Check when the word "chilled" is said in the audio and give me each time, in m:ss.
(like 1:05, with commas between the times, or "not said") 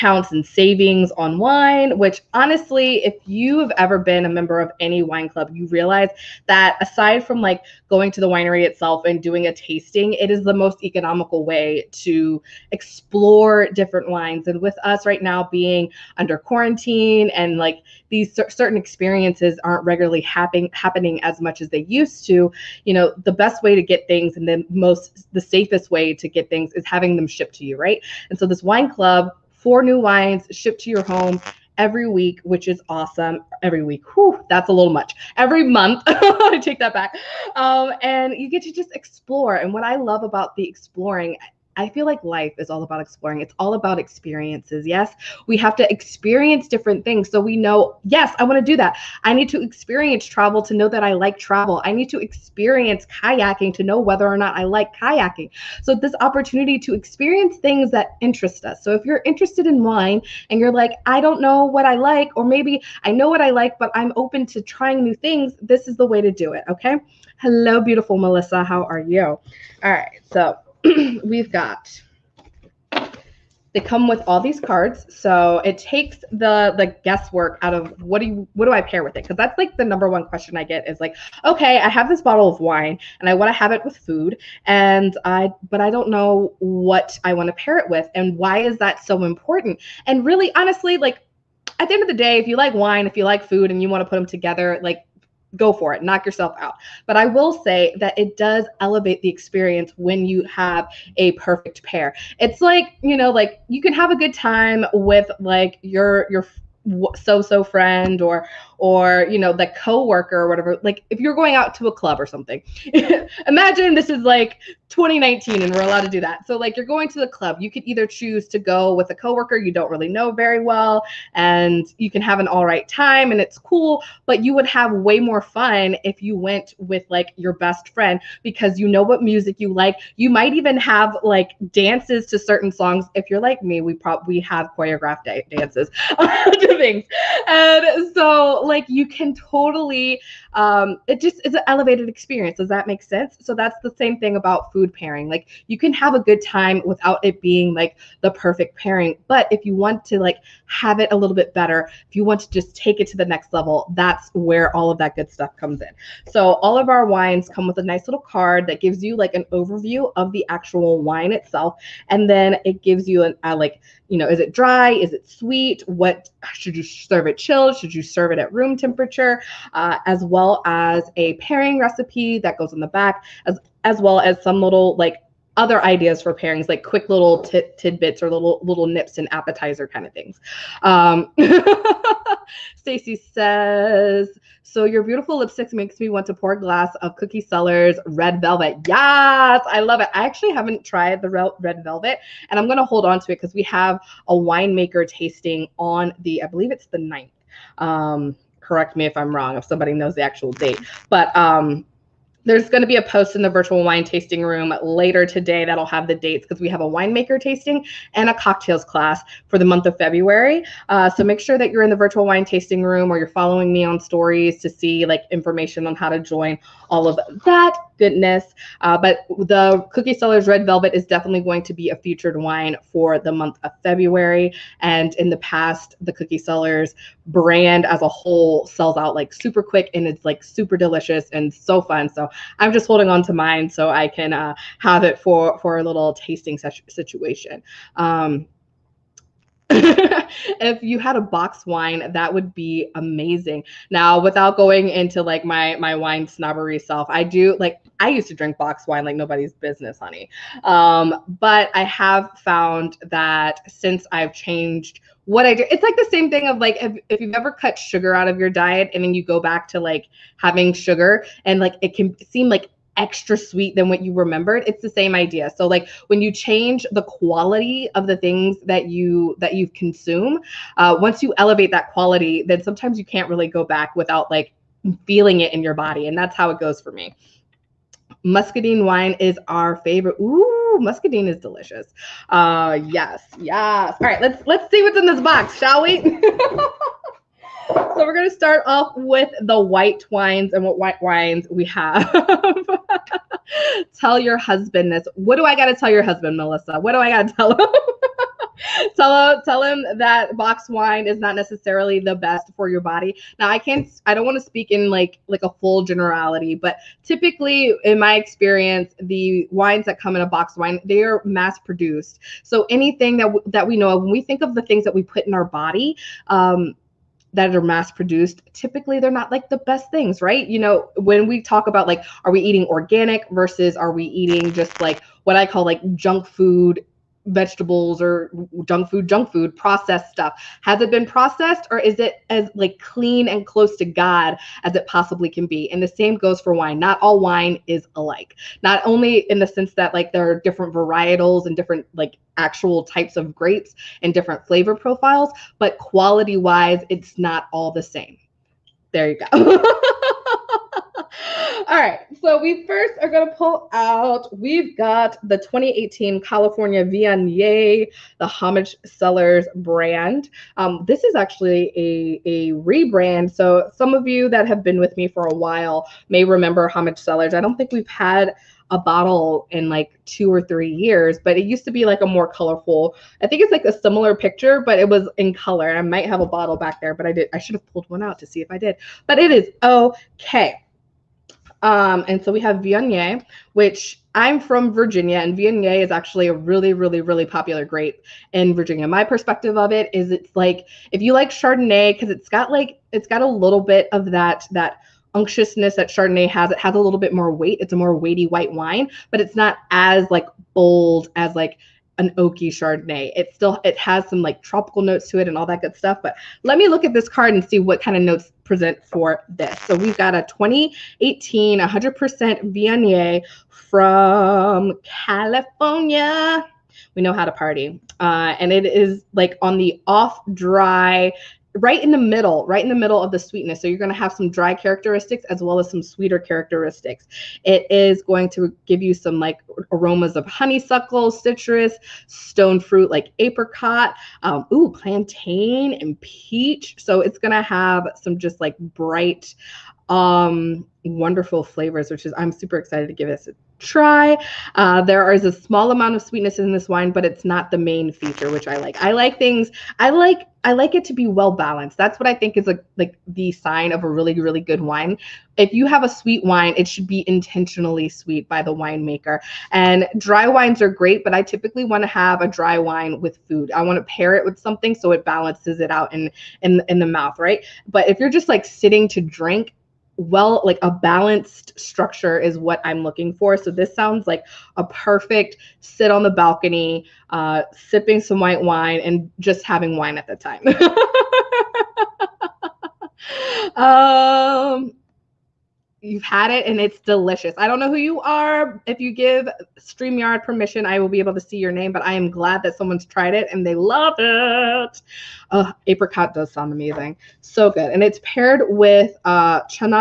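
2:47.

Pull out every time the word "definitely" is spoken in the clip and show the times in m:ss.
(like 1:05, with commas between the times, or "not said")
3:41.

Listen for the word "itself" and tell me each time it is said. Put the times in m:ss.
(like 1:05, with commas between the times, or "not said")
0:08, 2:41.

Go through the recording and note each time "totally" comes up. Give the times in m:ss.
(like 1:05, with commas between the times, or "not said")
2:19.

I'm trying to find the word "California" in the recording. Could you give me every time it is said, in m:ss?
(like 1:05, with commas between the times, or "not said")
5:56, 6:54.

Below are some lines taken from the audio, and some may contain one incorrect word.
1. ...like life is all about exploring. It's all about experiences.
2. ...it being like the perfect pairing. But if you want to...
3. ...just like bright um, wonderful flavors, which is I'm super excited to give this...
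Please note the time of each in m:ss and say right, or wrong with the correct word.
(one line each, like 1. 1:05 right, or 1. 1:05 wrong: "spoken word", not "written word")
1. 0:42 right
2. 2:27 right
3. 7:18 right.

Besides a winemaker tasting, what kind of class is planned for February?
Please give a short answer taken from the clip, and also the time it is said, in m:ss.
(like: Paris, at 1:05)
cocktails class, at 3:28.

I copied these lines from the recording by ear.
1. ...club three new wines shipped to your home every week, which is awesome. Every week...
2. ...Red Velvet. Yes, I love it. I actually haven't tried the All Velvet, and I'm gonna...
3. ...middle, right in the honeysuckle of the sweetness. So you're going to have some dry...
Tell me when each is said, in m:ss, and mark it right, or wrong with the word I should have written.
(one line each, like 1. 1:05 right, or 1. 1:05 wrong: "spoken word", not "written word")
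1. 0:28 wrong: "four", not "three"
2. 3:08 wrong: "Red", not "All"
3. 7:01 wrong: "middle", not "honeysuckle".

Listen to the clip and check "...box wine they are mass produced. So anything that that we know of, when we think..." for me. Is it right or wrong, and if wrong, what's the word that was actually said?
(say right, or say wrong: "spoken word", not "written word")
right.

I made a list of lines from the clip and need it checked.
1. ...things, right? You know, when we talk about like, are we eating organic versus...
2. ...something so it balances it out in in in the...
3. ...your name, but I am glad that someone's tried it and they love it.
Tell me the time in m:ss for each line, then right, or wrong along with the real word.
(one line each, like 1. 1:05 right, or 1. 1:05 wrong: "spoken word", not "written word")
1. 5:19 right
2. 7:44 right
3. 8:11 right.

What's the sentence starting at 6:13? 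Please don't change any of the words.
I think it's like a similar picture, but it was in color.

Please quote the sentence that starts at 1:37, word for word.
But I will say that it does elevate the experience when you have a perfect pair.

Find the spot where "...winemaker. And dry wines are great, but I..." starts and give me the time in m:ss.
7:38.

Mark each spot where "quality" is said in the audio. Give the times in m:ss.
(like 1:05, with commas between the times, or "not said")
4:27, 4:31, 5:45.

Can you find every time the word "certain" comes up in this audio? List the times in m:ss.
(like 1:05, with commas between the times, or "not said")
0:18, 2:12.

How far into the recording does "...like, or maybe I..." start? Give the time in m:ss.
1:01.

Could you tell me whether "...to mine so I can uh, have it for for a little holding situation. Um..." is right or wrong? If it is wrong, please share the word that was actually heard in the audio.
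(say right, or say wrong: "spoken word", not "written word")
wrong: "tasting", not "holding".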